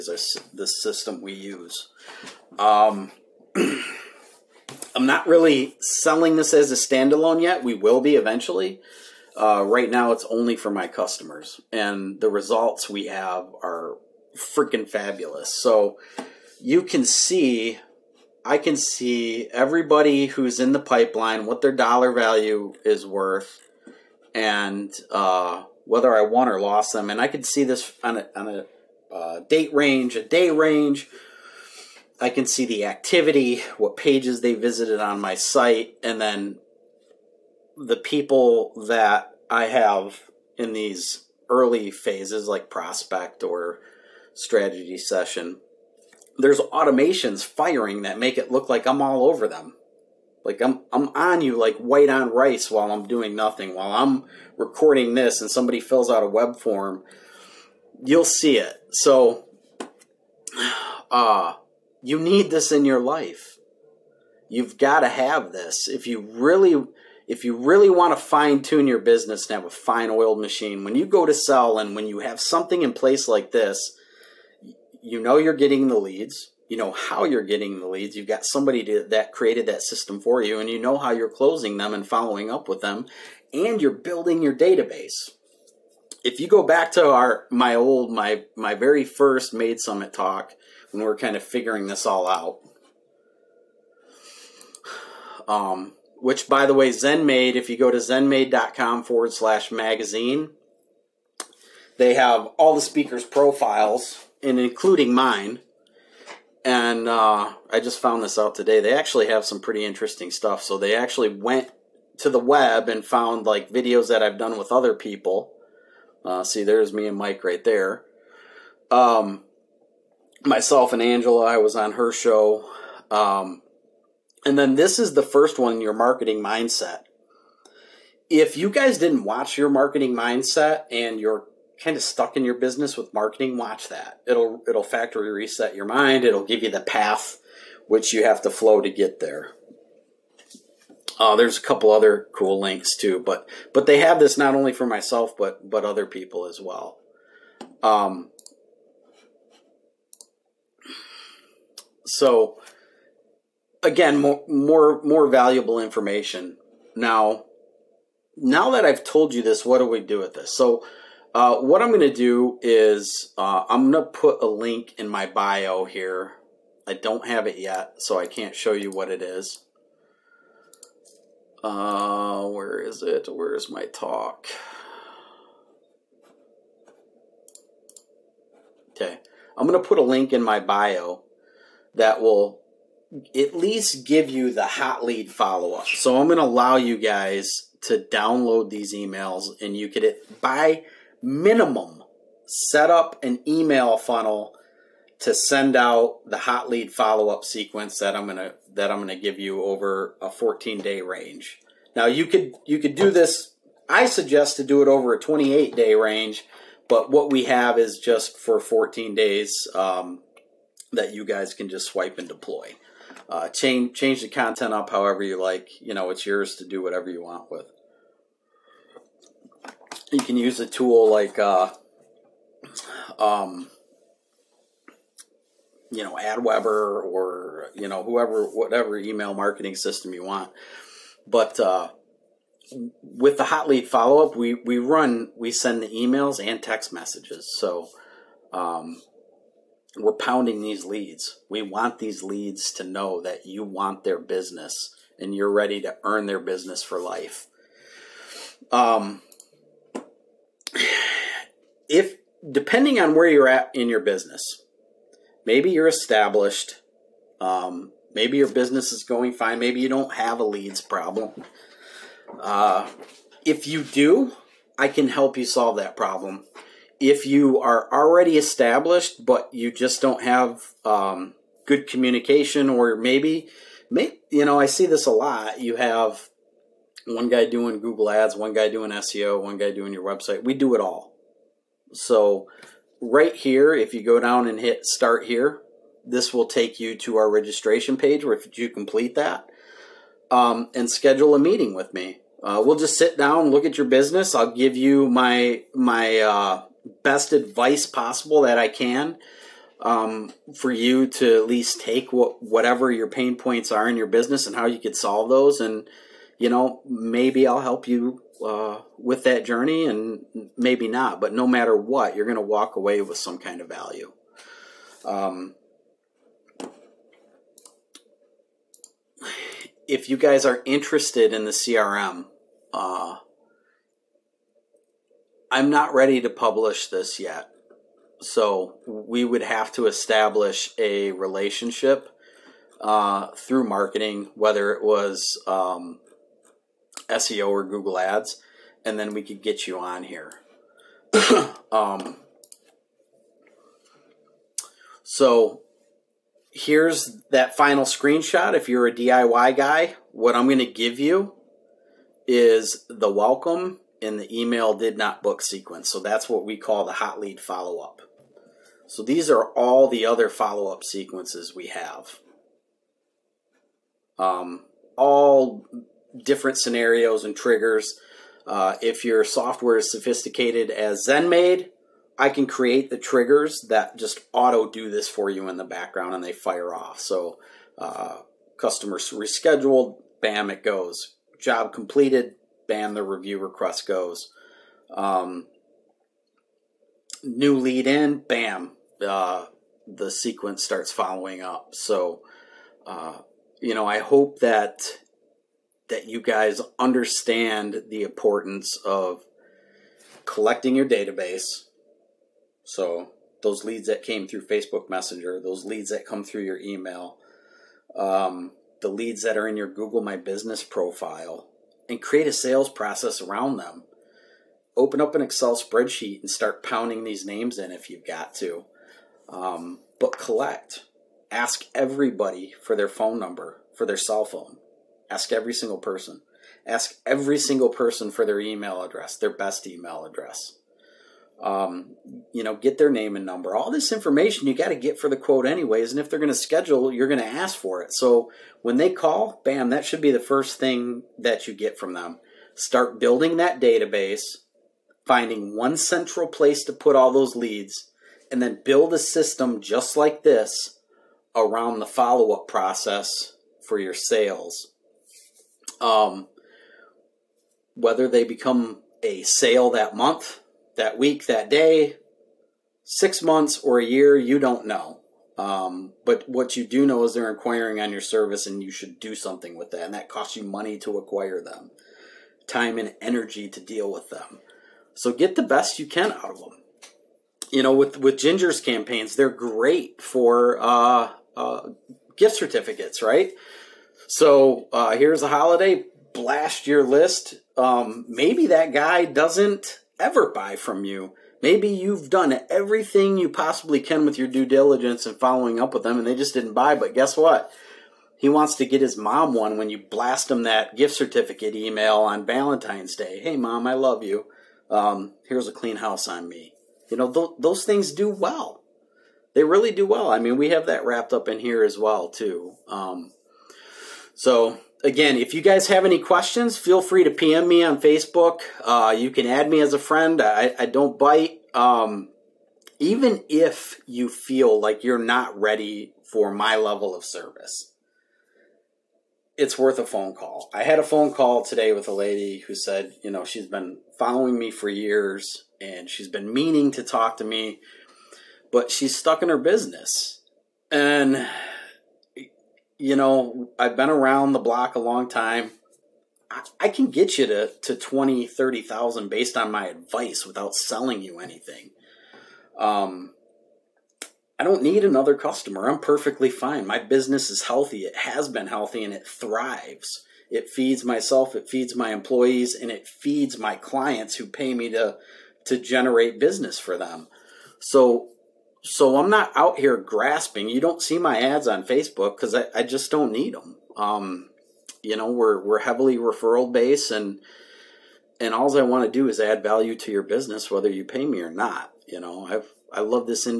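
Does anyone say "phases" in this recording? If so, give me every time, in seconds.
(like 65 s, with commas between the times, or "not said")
41 s.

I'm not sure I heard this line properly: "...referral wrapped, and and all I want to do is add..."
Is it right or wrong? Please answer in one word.
wrong.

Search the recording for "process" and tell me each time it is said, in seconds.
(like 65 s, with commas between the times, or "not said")
412 s, 452 s.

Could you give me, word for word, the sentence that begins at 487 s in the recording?
Um, maybe that guy doesn't ever buy from you.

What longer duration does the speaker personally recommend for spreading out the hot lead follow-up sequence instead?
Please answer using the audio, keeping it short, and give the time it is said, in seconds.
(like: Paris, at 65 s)
28 days, at 205 s.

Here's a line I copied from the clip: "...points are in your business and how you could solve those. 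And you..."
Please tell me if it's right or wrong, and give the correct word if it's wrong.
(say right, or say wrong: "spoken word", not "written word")
right.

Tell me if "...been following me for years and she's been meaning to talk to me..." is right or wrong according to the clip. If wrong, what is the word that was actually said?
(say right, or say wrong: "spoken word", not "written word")
right.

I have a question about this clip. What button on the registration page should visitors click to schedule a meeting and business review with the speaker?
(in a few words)
Start here.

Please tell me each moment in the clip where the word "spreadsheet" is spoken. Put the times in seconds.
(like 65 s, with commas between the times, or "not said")
415 s.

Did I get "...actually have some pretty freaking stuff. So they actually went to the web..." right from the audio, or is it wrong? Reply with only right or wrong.
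wrong.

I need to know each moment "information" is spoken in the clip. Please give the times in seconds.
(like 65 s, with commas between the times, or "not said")
155 s, 433 s.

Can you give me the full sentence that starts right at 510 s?
I mean, we have that wrapped up in here as well, too.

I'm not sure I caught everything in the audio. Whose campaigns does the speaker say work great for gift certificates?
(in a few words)
Ginger.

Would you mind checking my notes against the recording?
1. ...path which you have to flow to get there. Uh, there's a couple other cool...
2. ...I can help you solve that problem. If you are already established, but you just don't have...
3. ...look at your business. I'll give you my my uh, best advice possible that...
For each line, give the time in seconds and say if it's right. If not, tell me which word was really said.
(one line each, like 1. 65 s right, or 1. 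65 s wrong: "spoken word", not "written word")
1. 136 s right
2. 264 s right
3. 293 s right.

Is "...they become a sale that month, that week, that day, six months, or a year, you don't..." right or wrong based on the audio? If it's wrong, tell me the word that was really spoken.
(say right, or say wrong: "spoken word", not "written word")
right.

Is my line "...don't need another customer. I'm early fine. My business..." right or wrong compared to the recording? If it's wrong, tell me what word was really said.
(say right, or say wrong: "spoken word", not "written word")
wrong: "perfectly", not "early".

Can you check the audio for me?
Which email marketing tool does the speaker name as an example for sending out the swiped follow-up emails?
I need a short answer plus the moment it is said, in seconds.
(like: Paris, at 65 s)
AWeber, at 226 s.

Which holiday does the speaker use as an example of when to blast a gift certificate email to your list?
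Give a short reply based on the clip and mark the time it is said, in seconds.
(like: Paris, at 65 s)
Valentine's Day, at 502 s.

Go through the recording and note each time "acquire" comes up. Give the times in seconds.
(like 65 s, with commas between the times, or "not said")
470 s.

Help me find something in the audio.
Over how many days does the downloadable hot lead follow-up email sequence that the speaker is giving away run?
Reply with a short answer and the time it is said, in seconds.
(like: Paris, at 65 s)
14, at 200 s.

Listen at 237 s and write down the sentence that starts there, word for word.
So um, we're pounding these leads.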